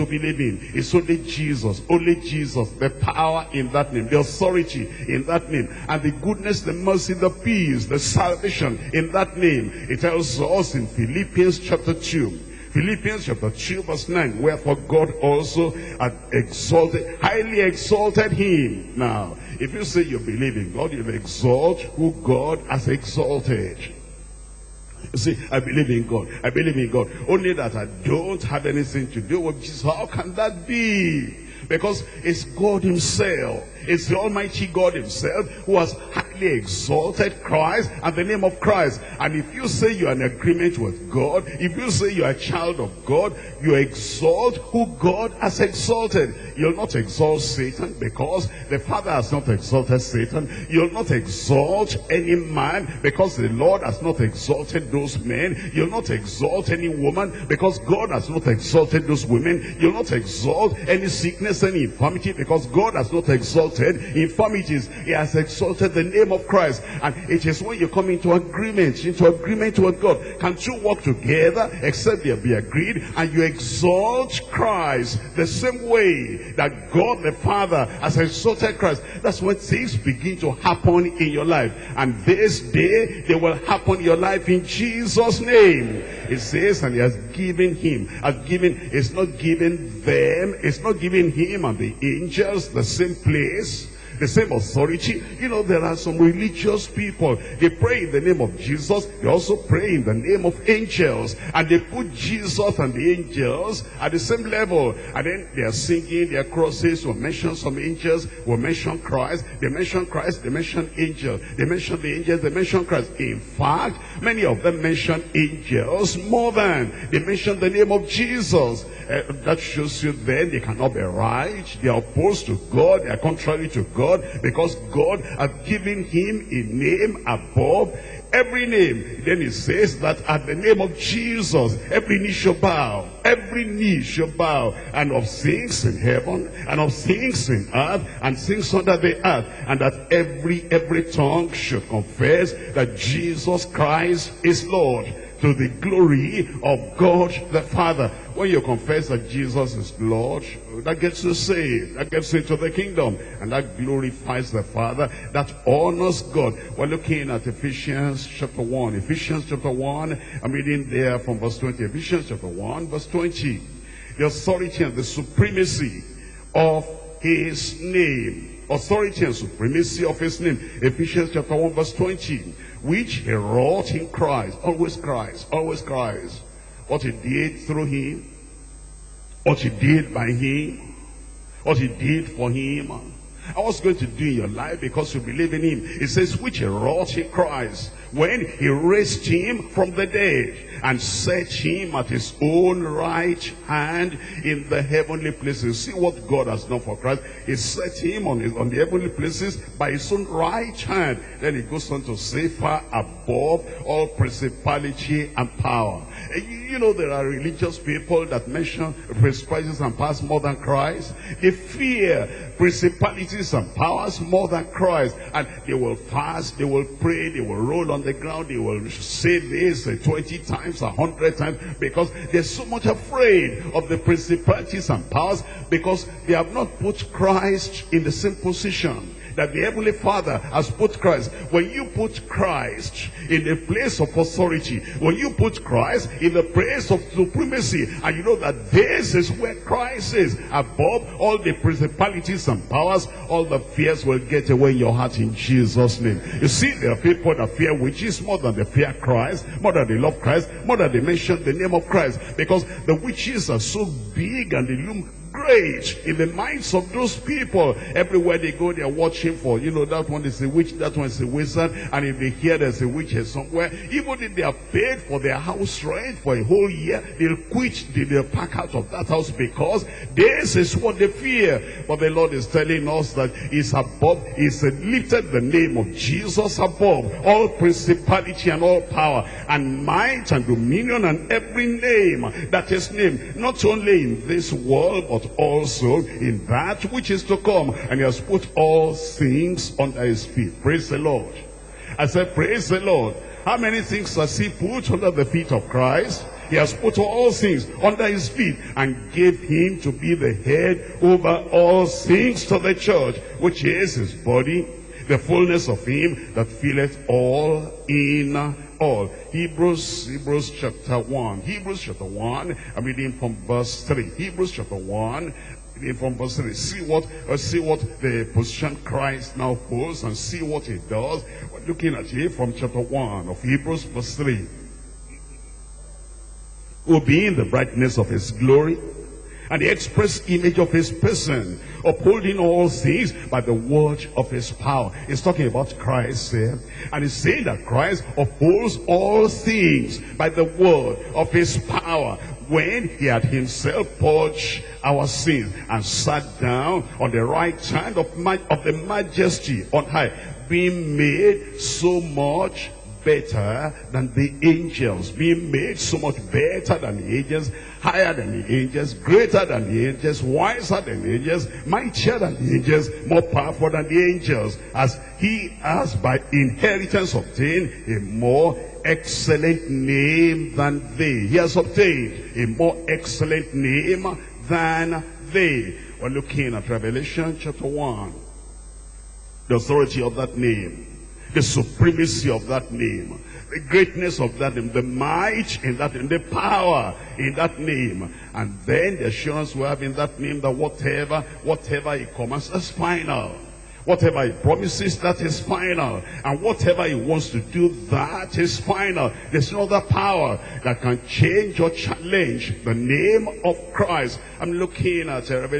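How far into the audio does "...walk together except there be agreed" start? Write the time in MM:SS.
01:10.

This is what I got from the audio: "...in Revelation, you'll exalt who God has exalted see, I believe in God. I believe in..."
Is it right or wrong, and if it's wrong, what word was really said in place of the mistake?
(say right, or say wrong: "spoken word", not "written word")
wrong: "God", not "Revelation".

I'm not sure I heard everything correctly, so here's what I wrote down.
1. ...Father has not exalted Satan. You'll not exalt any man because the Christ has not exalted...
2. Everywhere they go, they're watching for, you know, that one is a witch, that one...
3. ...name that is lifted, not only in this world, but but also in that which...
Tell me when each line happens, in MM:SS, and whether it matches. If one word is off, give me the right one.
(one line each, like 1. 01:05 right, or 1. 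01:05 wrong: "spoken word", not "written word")
1. 00:48 wrong: "Lord", not "Christ"
2. 04:17 right
3. 04:41 wrong: "named", not "lifted".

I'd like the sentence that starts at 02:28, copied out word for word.
When you confess that Jesus is Lord, that gets you saved.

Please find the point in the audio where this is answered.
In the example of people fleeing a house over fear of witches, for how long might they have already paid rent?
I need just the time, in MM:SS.
04:26.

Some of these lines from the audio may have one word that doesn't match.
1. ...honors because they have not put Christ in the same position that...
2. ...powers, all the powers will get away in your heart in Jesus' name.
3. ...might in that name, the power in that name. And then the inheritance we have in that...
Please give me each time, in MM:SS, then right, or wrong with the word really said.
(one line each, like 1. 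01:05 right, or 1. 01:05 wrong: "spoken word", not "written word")
1. 03:45 wrong: "powers", not "honors"
2. 04:02 wrong: "fears", not "powers"
3. 06:24 wrong: "assurance", not "inheritance".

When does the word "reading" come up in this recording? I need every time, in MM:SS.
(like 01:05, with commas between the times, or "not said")
02:40, 05:12.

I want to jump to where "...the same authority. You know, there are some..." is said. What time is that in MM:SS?
01:34.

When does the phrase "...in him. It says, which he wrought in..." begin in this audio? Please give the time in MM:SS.
03:05.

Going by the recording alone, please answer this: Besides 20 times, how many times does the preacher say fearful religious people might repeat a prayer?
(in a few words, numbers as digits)
100 times.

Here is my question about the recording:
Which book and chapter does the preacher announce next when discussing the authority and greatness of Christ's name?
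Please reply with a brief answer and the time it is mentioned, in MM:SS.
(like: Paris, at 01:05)
Revelation chapter 1, at 06:16.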